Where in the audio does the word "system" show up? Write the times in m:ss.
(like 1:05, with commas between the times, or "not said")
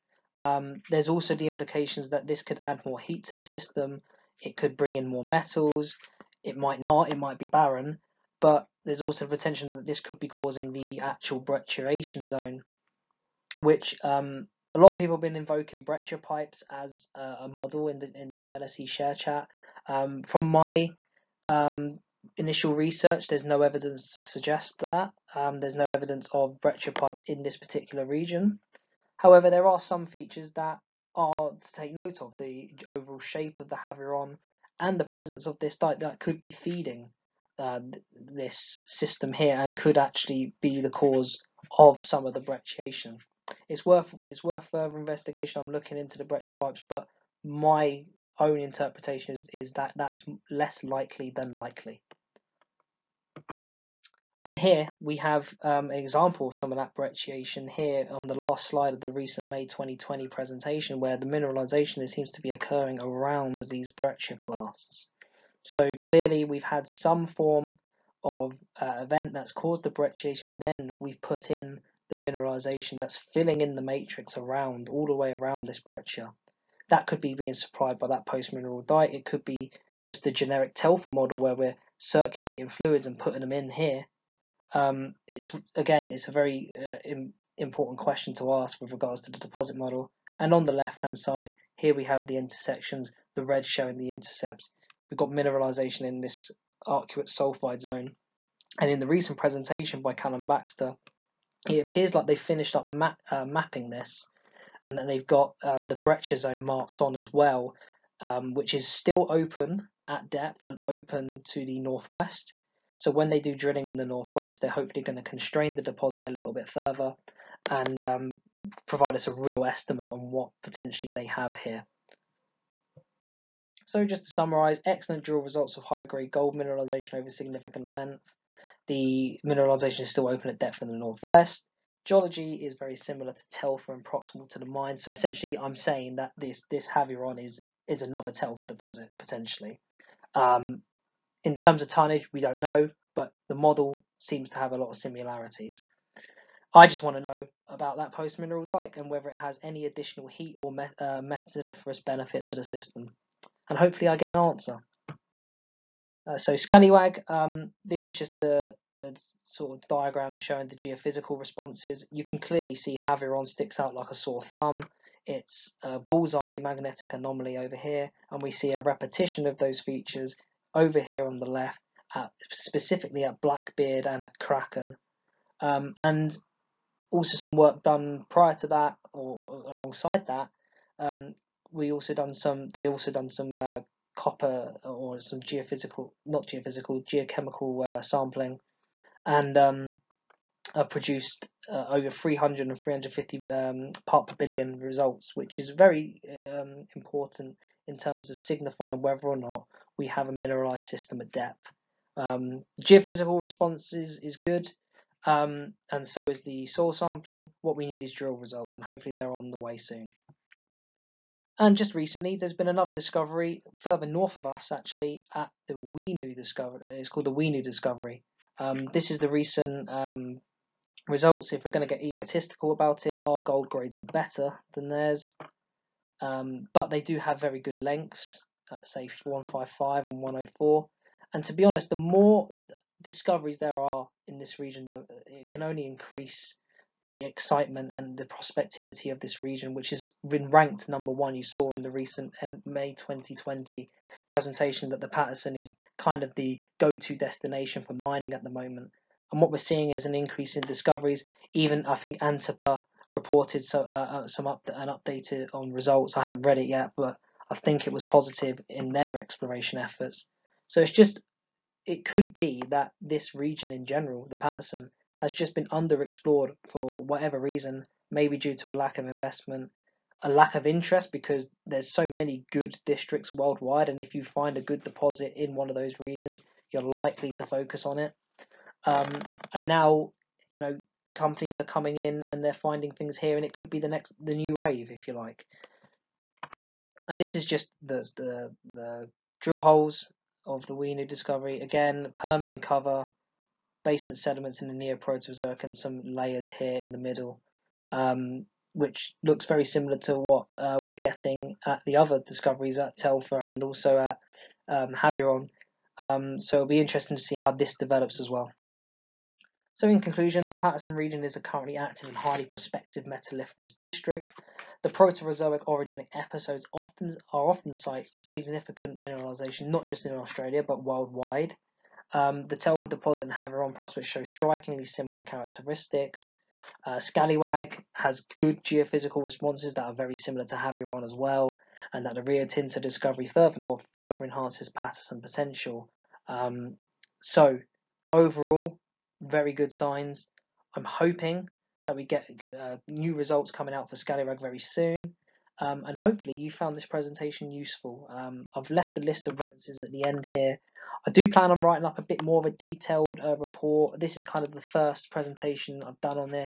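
0:03, 0:38, 2:32, 3:20.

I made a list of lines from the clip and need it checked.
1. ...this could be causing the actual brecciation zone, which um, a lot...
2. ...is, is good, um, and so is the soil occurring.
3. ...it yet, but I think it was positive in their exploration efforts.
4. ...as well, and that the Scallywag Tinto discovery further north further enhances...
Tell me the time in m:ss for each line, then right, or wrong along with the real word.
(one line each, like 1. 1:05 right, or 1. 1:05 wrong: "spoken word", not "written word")
1. 0:09 right
2. 3:23 wrong: "sampling", not "occurring"
3. 4:16 right
4. 5:31 wrong: "Rio", not "Scallywag".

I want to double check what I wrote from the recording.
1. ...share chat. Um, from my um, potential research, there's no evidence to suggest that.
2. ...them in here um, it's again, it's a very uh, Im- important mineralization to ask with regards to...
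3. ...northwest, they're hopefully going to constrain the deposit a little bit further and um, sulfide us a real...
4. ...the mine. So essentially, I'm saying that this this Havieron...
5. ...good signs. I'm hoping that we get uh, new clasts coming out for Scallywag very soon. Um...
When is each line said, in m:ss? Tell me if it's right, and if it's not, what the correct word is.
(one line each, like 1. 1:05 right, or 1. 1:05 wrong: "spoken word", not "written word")
1. 0:18 wrong: "initial", not "potential"
2. 1:23 wrong: "question", not "mineralization"
3. 1:54 wrong: "provide", not "sulfide"
4. 2:14 right
5. 5:39 wrong: "results", not "clasts".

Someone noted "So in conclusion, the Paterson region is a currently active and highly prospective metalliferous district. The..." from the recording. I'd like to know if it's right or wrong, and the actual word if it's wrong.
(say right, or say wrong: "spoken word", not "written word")
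right.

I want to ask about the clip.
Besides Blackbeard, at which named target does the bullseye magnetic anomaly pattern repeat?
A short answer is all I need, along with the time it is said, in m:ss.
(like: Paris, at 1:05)
Kraken, at 2:54.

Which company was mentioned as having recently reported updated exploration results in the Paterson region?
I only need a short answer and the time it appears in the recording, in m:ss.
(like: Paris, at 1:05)
Antipa, at 4:12.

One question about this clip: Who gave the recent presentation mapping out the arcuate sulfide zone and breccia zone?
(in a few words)
Callum Baxter.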